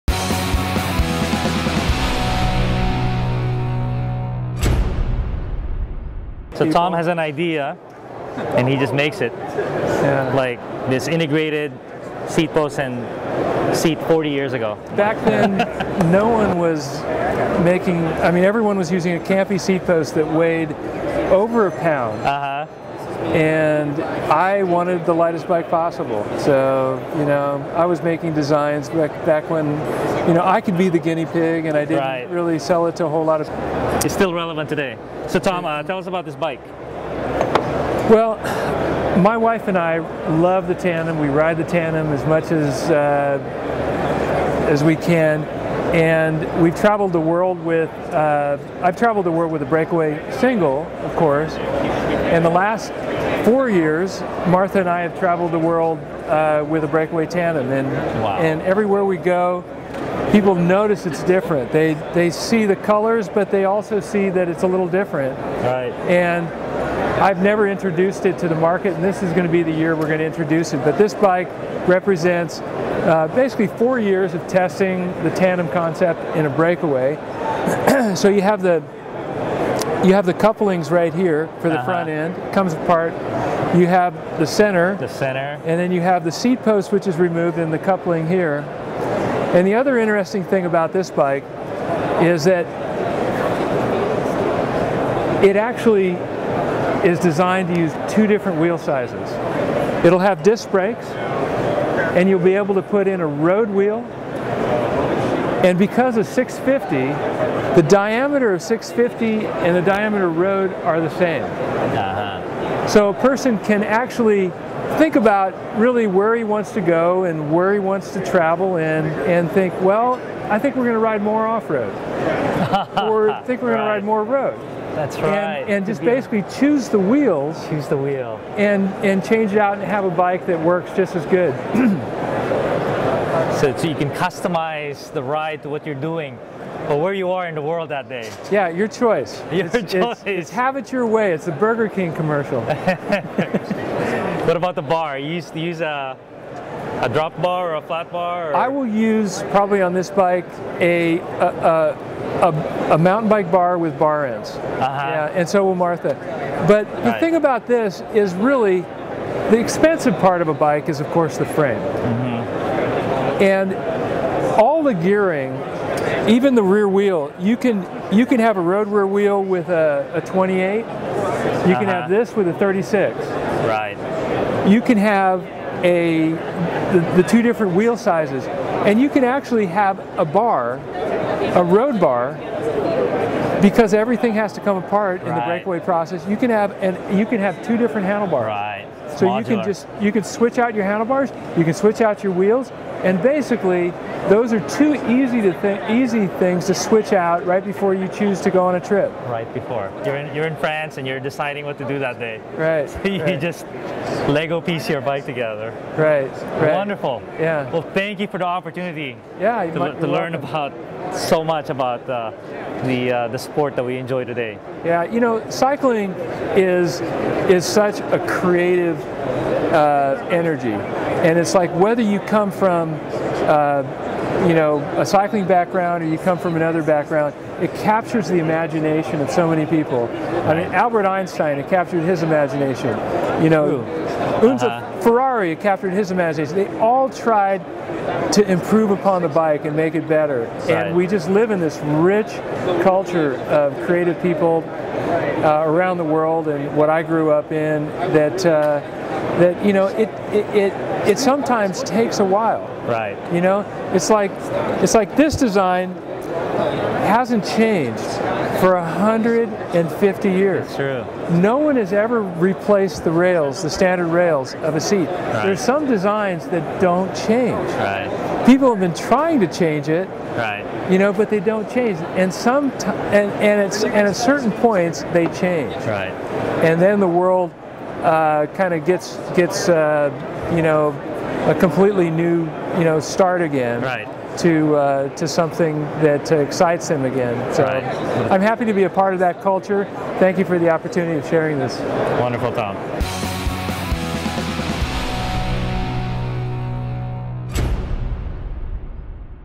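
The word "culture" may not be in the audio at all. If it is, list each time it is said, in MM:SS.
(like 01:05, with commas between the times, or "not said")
04:02, 04:49.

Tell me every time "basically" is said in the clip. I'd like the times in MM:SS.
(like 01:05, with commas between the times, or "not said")
01:13, 02:06, 03:13.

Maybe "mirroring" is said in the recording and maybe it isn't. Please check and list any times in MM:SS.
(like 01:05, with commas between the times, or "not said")
not said.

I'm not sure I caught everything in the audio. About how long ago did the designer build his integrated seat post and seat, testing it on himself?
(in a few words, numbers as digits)
40 years.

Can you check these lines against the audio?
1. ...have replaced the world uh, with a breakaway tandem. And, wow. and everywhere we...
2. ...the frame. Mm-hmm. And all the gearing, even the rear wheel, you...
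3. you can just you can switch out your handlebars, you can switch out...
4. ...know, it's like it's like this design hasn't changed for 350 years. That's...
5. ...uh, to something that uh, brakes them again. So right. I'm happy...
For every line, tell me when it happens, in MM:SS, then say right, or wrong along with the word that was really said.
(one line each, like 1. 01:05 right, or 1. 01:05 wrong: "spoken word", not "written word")
1. 00:55 wrong: "traveled", not "replaced"
2. 02:41 right
3. 03:09 right
4. 04:13 wrong: "150", not "350"
5. 04:44 wrong: "excites", not "brakes".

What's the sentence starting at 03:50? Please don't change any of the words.
I mean, Albert Einstein, it captured his imagination.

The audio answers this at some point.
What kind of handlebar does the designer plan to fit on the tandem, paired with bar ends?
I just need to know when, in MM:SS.
02:32.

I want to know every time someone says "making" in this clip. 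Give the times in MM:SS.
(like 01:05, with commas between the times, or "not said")
00:17, 00:28.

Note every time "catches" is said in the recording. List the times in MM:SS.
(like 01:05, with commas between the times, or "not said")
not said.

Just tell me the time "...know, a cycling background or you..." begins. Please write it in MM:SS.
03:44.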